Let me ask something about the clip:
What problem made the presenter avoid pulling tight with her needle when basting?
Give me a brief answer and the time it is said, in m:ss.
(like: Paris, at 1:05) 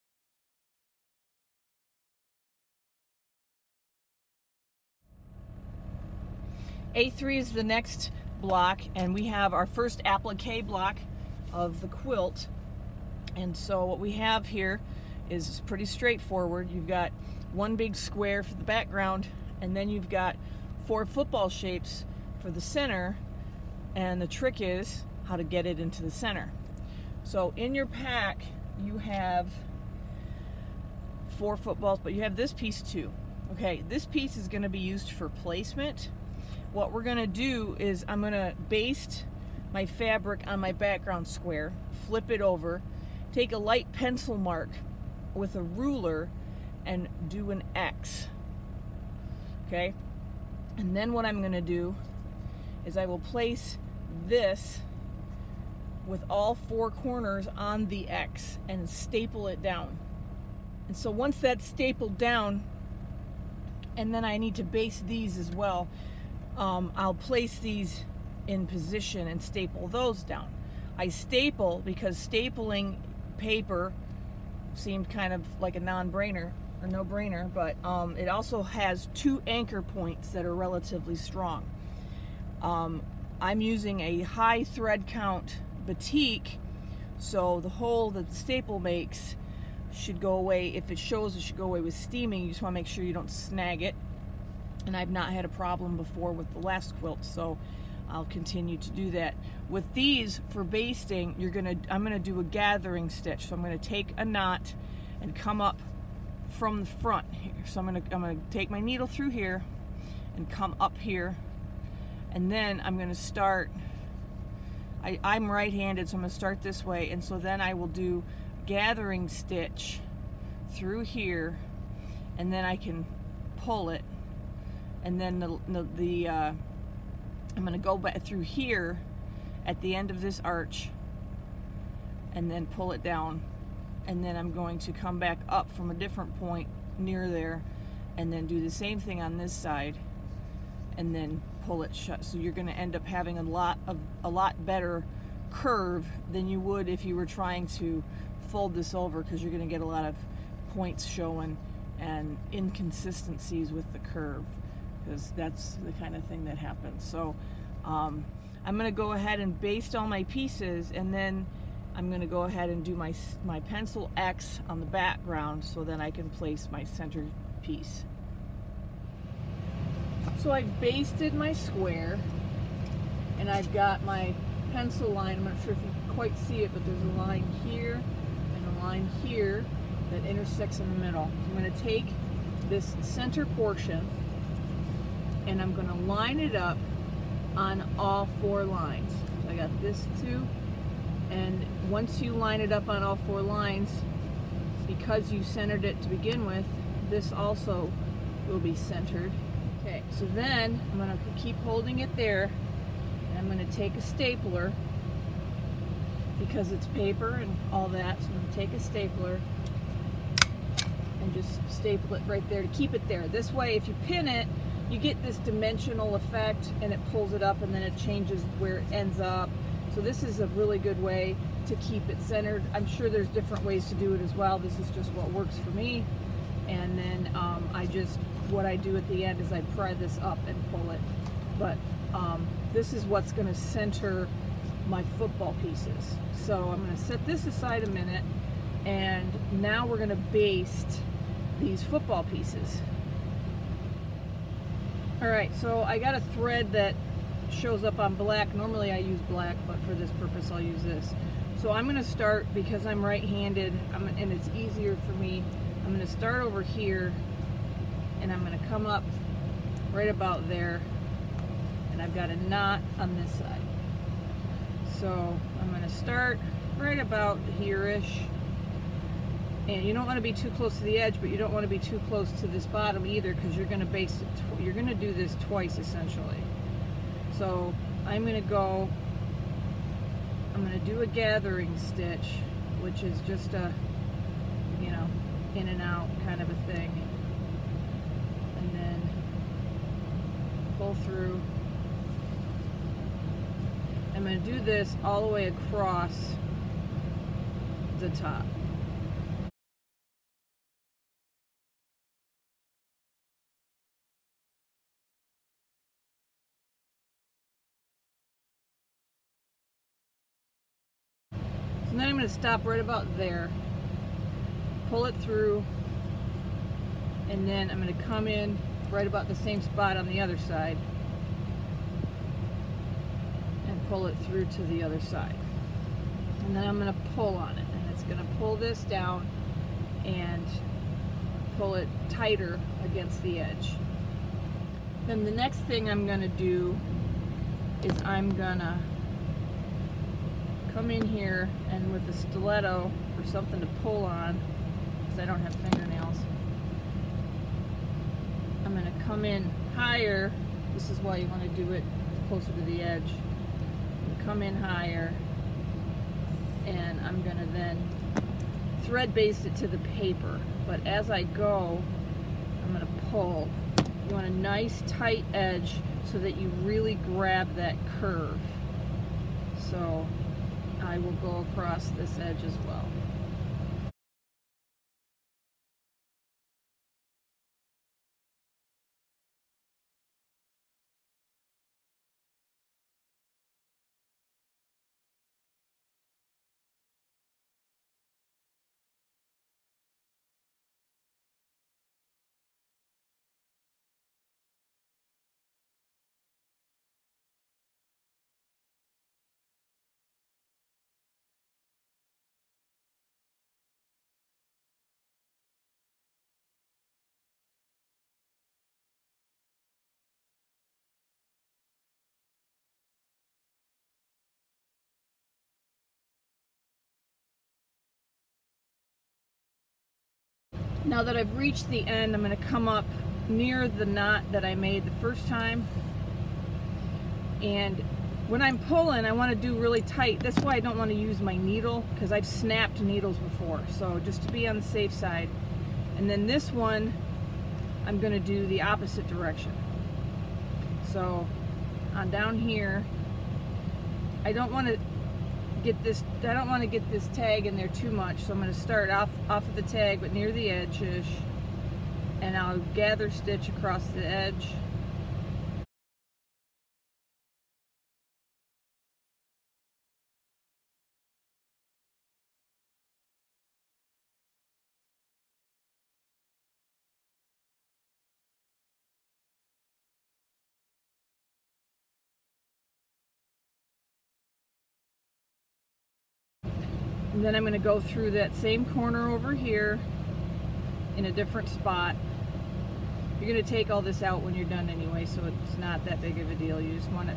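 snapped needles, at 7:12.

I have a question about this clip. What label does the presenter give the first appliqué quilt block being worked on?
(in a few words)
A3.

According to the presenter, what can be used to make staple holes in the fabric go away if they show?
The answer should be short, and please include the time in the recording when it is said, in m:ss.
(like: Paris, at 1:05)
steaming, at 1:31.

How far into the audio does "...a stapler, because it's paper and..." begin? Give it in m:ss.
3:23.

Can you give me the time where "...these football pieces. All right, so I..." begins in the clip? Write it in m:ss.
4:01.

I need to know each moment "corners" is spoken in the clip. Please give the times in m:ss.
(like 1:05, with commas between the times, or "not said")
0:56, 7:58.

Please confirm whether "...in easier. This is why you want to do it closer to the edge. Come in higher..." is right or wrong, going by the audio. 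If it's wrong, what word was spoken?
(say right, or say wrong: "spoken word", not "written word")
wrong: "higher", not "easier".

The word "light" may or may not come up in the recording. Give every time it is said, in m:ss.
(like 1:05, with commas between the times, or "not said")
0:43.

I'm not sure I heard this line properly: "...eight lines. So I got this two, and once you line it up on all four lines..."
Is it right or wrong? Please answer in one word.
wrong.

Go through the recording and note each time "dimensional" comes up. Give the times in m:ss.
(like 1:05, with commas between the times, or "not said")
3:35.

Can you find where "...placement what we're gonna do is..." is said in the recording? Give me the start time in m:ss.
0:35.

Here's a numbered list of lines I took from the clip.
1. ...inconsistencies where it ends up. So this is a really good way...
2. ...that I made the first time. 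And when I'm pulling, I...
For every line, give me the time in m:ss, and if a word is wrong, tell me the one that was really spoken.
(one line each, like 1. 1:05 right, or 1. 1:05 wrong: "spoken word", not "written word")
1. 3:37 wrong: "changes", not "inconsistencies"
2. 7:04 right.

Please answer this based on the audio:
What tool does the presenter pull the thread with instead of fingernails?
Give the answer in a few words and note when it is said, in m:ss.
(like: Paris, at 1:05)
stiletto, at 5:42.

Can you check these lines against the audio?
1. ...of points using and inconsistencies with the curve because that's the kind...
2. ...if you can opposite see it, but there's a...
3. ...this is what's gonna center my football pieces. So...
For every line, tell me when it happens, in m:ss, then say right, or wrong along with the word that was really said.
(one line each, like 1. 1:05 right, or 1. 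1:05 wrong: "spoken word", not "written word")
1. 2:30 wrong: "showing", not "using"
2. 2:55 wrong: "quite", not "opposite"
3. 3:52 right.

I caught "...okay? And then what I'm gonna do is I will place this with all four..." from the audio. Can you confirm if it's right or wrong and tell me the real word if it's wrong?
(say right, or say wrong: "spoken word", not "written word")
right.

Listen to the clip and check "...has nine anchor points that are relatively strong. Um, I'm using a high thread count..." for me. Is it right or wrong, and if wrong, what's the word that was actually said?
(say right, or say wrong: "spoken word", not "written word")
wrong: "two", not "nine".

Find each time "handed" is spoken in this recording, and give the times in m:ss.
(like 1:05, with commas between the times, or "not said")
1:55, 4:13.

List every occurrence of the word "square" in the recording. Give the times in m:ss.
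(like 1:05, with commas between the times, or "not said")
0:17, 0:41, 2:51.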